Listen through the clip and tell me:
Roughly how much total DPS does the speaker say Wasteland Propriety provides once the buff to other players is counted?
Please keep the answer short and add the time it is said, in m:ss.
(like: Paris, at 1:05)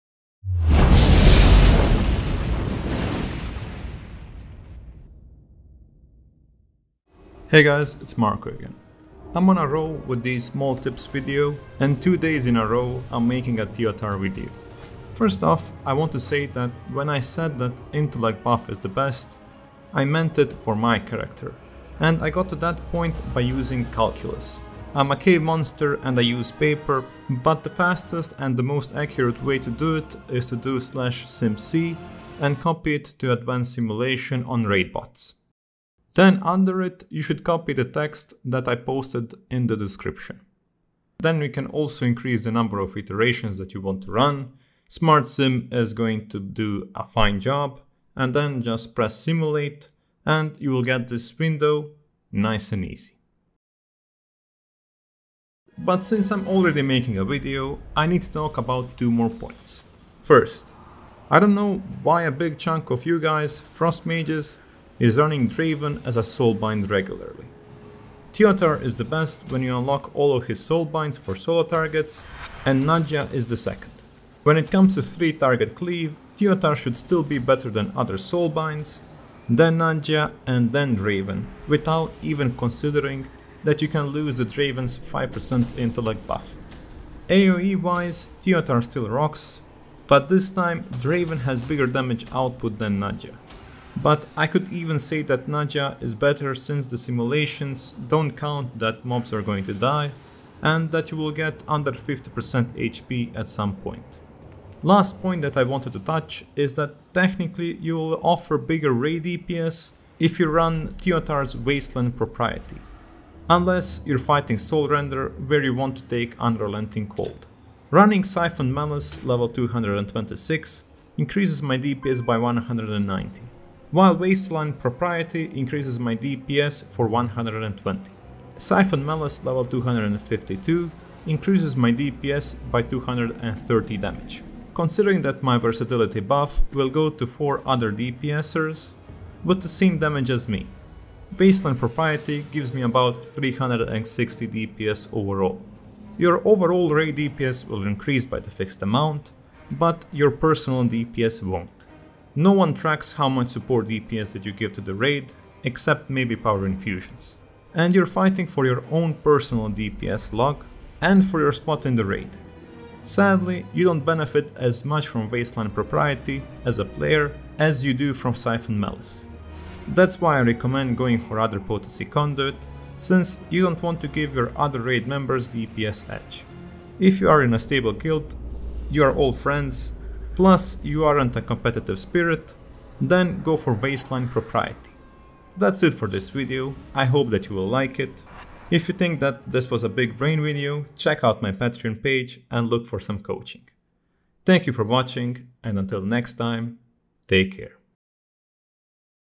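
360, at 2:23.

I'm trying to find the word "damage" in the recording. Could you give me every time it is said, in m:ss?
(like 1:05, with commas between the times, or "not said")
1:31, 2:13, 2:19.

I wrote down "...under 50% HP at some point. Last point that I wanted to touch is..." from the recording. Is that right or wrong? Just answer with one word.
right.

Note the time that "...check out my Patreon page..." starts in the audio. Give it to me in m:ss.
3:10.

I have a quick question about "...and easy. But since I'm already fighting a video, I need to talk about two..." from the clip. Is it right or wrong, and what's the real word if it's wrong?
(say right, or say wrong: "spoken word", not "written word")
wrong: "making", not "fighting".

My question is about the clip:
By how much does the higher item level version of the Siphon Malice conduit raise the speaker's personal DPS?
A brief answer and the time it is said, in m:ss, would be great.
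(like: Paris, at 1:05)
230, at 2:12.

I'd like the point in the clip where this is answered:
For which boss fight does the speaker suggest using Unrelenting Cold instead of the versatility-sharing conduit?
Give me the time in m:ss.
1:54.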